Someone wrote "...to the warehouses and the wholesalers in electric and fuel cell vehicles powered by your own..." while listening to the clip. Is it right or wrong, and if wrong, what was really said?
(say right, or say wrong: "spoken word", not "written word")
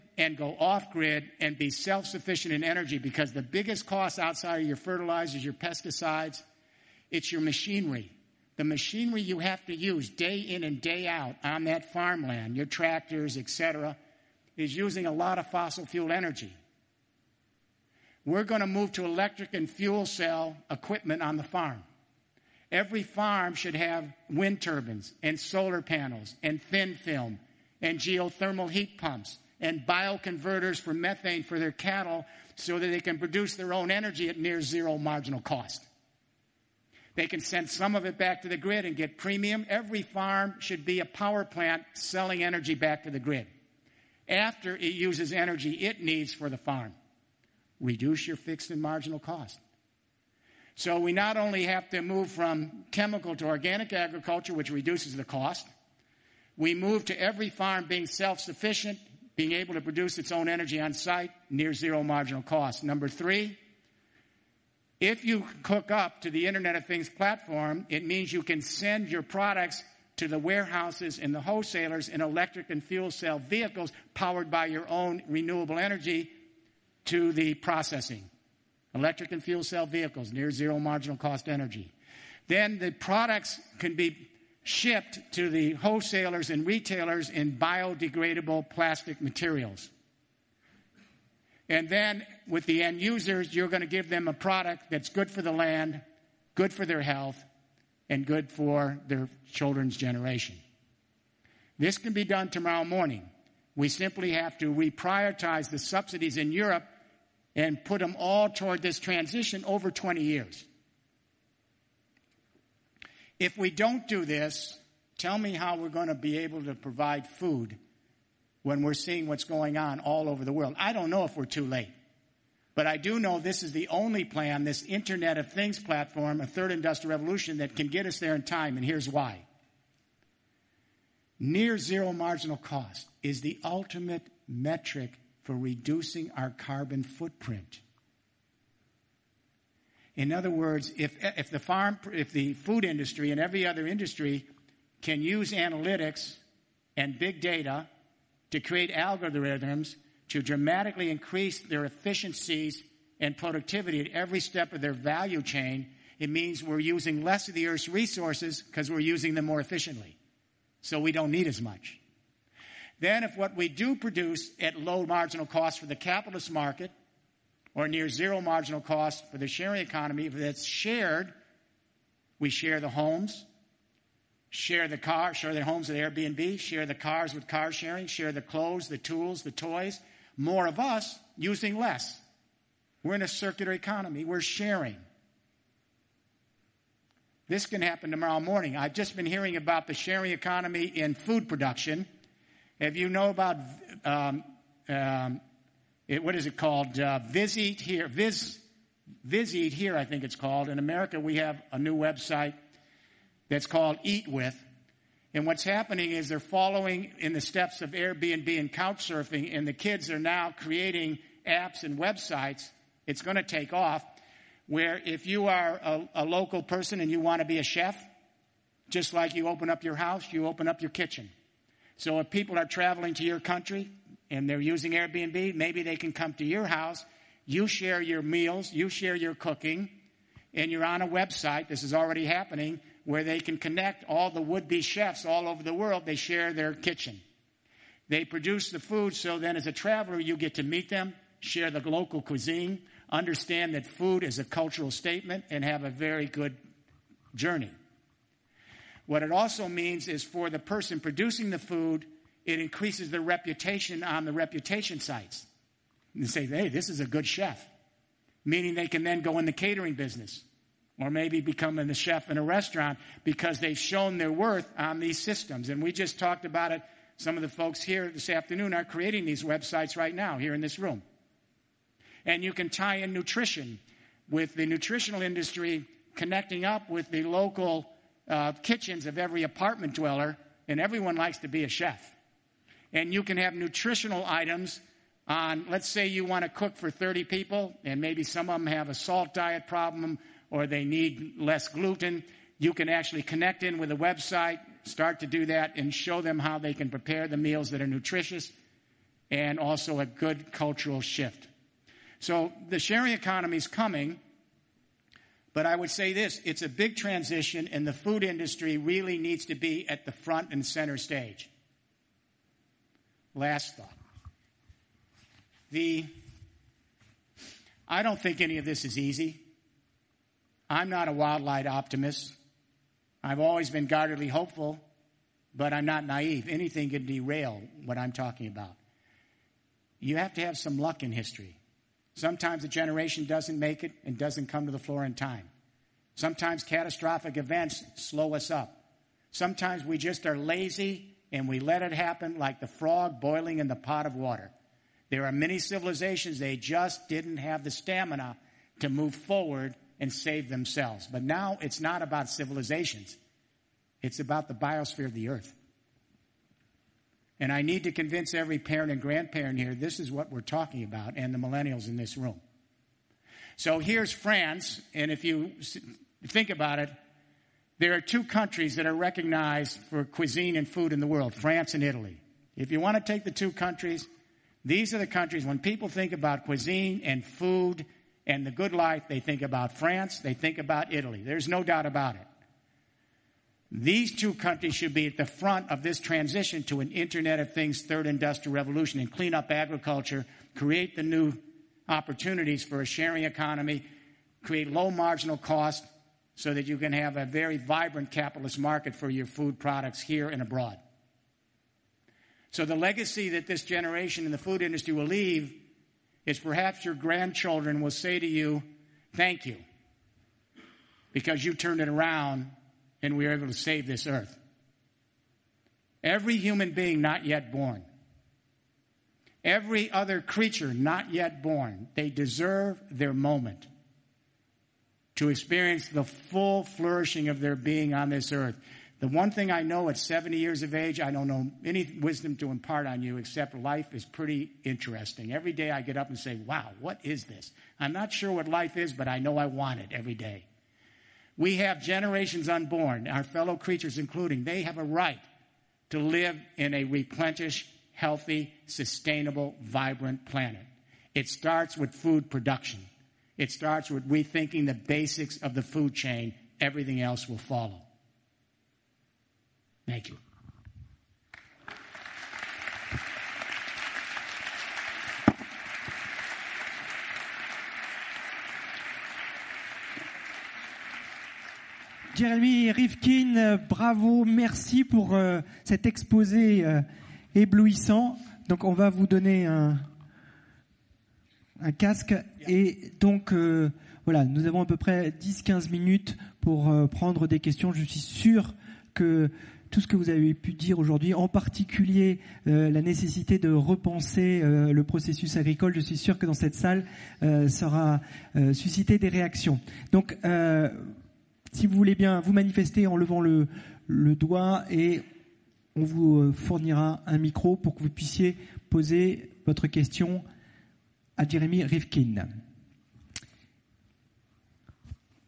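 right.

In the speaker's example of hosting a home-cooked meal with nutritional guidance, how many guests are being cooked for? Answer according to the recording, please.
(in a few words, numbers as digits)
30.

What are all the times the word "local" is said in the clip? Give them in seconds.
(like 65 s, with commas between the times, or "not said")
216 s, 241 s, 277 s.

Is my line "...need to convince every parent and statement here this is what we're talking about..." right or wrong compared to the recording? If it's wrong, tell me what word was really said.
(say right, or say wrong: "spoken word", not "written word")
wrong: "grandparent", not "statement".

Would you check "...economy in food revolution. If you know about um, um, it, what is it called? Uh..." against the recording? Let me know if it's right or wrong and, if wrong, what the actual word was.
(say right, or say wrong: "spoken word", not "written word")
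wrong: "production", not "revolution".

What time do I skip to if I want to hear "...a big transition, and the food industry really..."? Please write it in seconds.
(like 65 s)
306 s.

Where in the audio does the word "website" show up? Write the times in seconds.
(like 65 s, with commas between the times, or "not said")
201 s, 211 s, 231 s, 269 s, 293 s.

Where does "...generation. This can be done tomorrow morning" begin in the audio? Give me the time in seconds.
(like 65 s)
99 s.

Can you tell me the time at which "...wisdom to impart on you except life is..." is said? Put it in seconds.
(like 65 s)
432 s.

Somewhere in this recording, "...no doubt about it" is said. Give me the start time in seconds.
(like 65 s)
381 s.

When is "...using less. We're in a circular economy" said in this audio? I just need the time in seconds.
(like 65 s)
181 s.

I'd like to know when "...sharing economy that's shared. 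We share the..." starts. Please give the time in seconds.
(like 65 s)
169 s.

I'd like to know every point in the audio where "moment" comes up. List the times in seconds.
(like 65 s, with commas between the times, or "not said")
423 s.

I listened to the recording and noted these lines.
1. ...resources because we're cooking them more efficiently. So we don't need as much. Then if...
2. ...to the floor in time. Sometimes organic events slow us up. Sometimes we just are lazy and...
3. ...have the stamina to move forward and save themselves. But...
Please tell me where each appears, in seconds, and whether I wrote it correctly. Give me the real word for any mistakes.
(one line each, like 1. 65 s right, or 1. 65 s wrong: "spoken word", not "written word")
1. 157 s wrong: "using", not "cooking"
2. 334 s wrong: "catastrophic", not "organic"
3. 347 s right.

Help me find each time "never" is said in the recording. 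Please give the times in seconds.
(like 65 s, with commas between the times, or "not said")
not said.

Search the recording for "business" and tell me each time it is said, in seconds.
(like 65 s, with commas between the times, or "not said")
259 s.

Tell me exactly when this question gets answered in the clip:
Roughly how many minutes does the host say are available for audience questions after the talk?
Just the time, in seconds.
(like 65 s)
485 s.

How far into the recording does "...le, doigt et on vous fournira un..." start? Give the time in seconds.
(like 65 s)
503 s.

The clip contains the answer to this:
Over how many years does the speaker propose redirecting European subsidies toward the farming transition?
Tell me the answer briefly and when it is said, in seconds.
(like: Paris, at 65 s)
20 years, at 109 s.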